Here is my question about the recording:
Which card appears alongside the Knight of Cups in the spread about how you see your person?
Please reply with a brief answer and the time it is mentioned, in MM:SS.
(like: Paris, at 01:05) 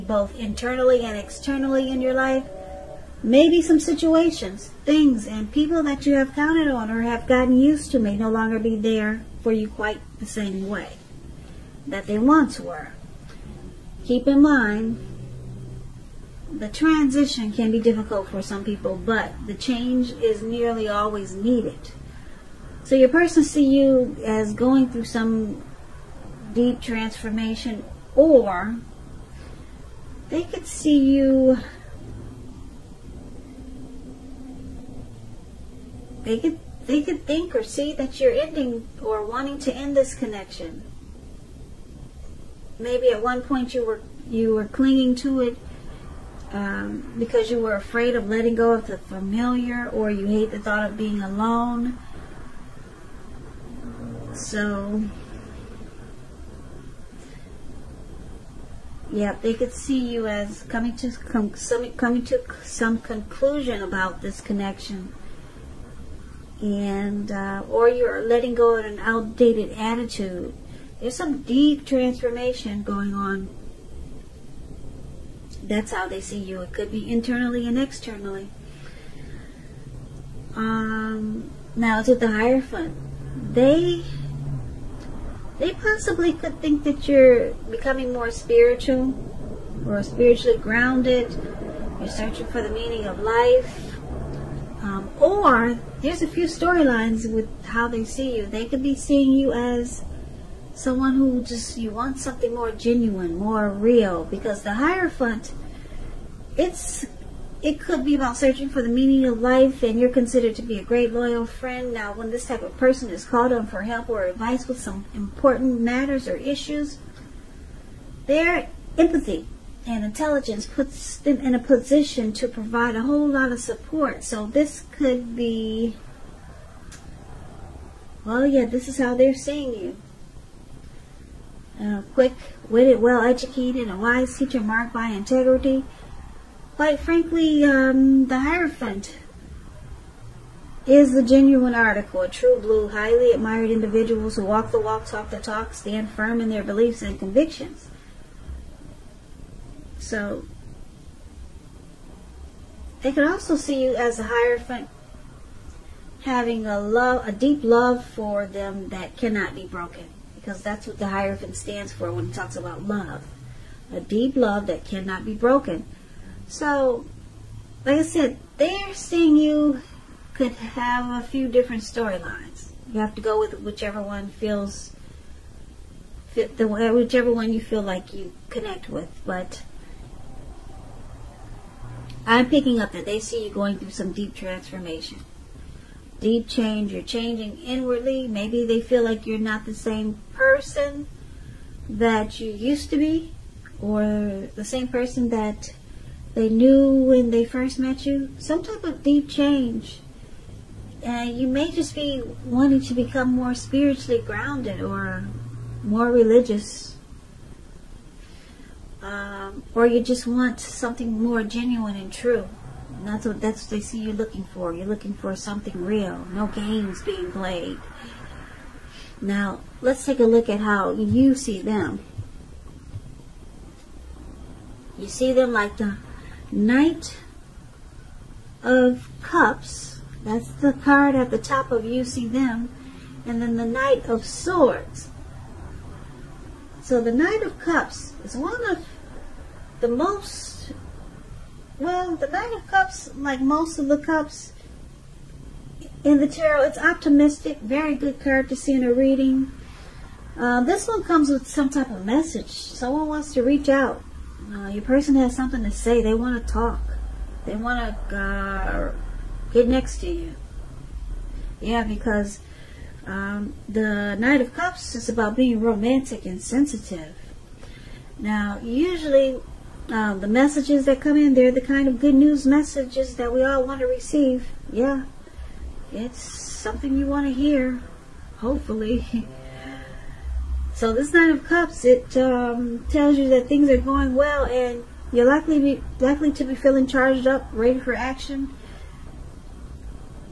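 Knight of Swords, at 03:53.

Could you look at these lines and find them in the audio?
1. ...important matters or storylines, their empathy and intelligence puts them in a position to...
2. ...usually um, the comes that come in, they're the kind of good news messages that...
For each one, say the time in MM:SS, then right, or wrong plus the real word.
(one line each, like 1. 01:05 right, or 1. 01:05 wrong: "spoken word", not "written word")
1. 01:55 wrong: "issues", not "storylines"
2. 04:28 wrong: "messages", not "comes".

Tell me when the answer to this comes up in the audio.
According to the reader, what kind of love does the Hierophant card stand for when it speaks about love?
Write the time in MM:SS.
02:43.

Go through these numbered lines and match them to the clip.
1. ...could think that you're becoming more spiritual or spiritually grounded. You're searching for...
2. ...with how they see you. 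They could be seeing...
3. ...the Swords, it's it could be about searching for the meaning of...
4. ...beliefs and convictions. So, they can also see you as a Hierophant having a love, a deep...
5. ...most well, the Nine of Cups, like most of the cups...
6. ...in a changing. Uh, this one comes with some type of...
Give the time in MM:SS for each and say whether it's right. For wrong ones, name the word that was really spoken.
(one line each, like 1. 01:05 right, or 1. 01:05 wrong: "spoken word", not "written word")
1. 01:26 right
2. 01:37 right
3. 01:44 wrong: "Hierophant", not "Swords"
4. 02:26 right
5. 03:59 right
6. 04:08 wrong: "reading", not "changing".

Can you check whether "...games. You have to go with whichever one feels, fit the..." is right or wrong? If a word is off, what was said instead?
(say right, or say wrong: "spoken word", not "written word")
wrong: "storylines", not "games".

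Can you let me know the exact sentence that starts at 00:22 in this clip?
So your person see you as going through some deep transformation, or they could see you.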